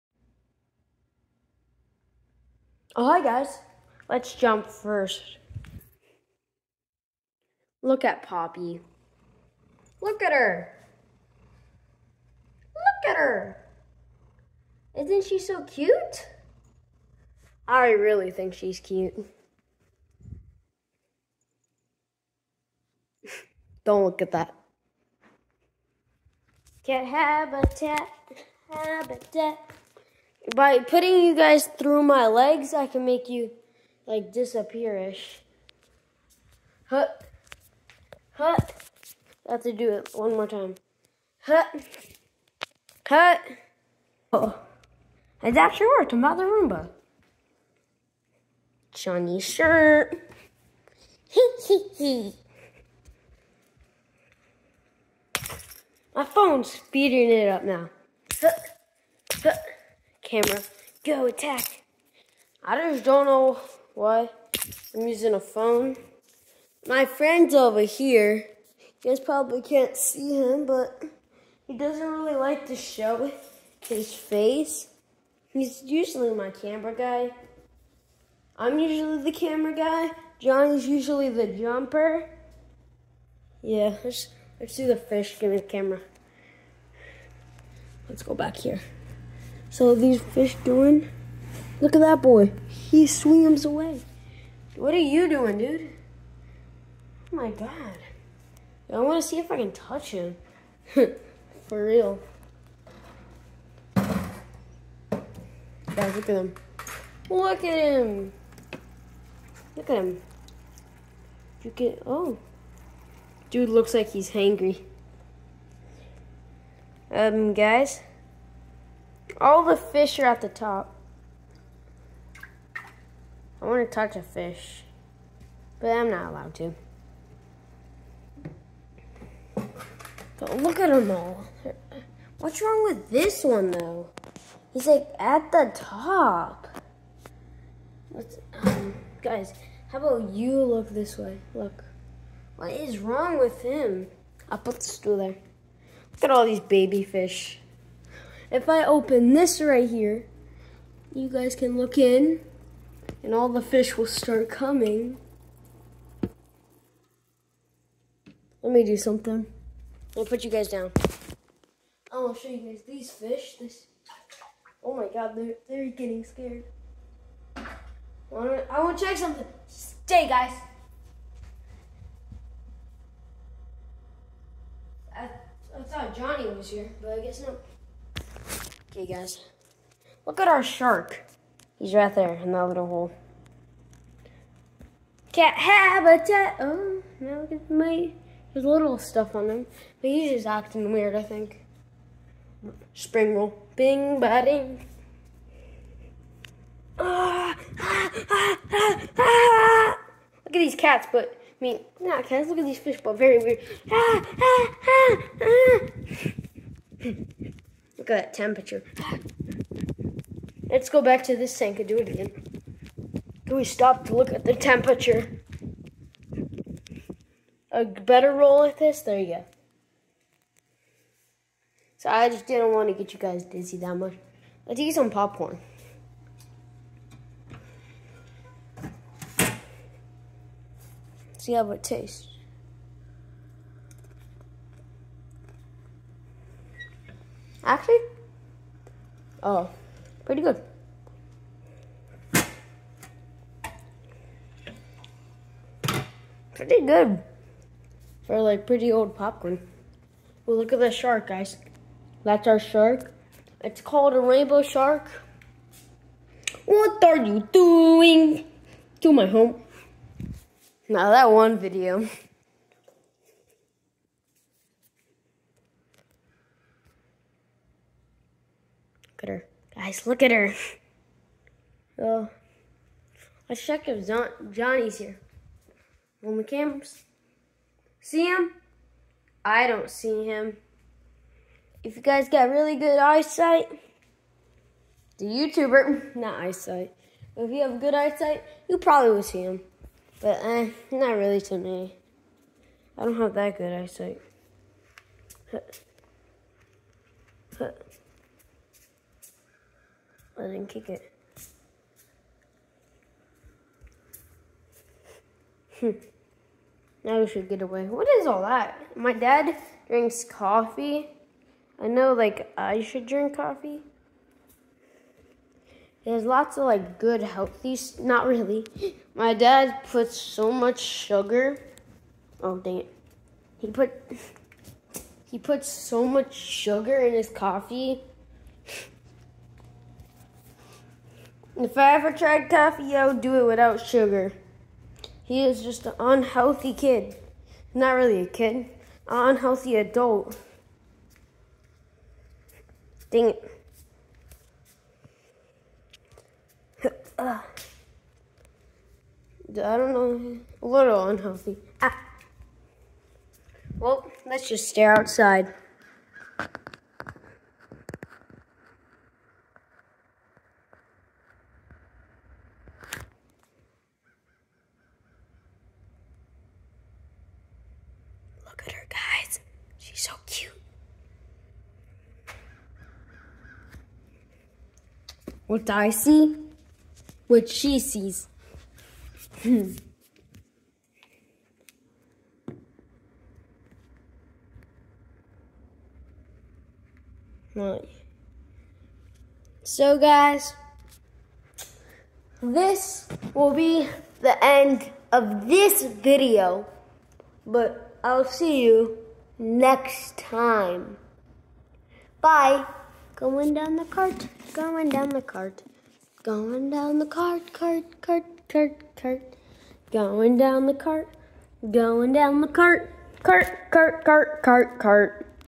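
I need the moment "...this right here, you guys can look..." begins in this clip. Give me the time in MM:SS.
02:29.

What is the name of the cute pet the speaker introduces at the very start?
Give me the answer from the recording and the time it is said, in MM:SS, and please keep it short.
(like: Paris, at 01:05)
Poppy, at 00:08.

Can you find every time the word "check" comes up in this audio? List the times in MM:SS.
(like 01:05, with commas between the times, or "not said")
02:49, 04:33.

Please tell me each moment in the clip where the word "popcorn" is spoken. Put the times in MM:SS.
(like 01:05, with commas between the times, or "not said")
03:45, 04:09.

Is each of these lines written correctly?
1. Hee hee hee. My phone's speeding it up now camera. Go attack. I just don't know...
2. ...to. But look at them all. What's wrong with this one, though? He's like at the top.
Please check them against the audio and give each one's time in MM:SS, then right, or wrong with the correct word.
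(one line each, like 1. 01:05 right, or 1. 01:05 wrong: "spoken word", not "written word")
1. 00:51 right
2. 02:06 right.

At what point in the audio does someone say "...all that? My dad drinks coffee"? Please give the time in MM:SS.
05:08.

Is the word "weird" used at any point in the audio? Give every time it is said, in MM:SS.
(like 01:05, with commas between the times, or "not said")
03:10, 03:23.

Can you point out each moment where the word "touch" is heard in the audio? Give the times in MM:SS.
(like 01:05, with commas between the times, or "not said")
01:39, 02:03.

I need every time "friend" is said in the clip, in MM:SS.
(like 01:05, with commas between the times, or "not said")
01:07.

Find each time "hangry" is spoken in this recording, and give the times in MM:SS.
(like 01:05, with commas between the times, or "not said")
01:54.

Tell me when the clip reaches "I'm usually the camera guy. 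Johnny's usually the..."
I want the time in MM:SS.
01:18.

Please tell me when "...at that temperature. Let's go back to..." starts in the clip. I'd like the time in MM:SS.
03:28.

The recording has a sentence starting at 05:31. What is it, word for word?
If I ever tried coffee, I would do it without sugar.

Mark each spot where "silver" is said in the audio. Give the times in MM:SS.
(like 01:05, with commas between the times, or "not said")
not said.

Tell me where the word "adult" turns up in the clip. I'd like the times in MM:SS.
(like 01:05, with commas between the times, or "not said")
05:39.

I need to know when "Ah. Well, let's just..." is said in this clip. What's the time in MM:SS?
05:51.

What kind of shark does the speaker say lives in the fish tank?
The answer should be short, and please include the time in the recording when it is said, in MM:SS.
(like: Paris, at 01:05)
Rainbow shark, at 04:14.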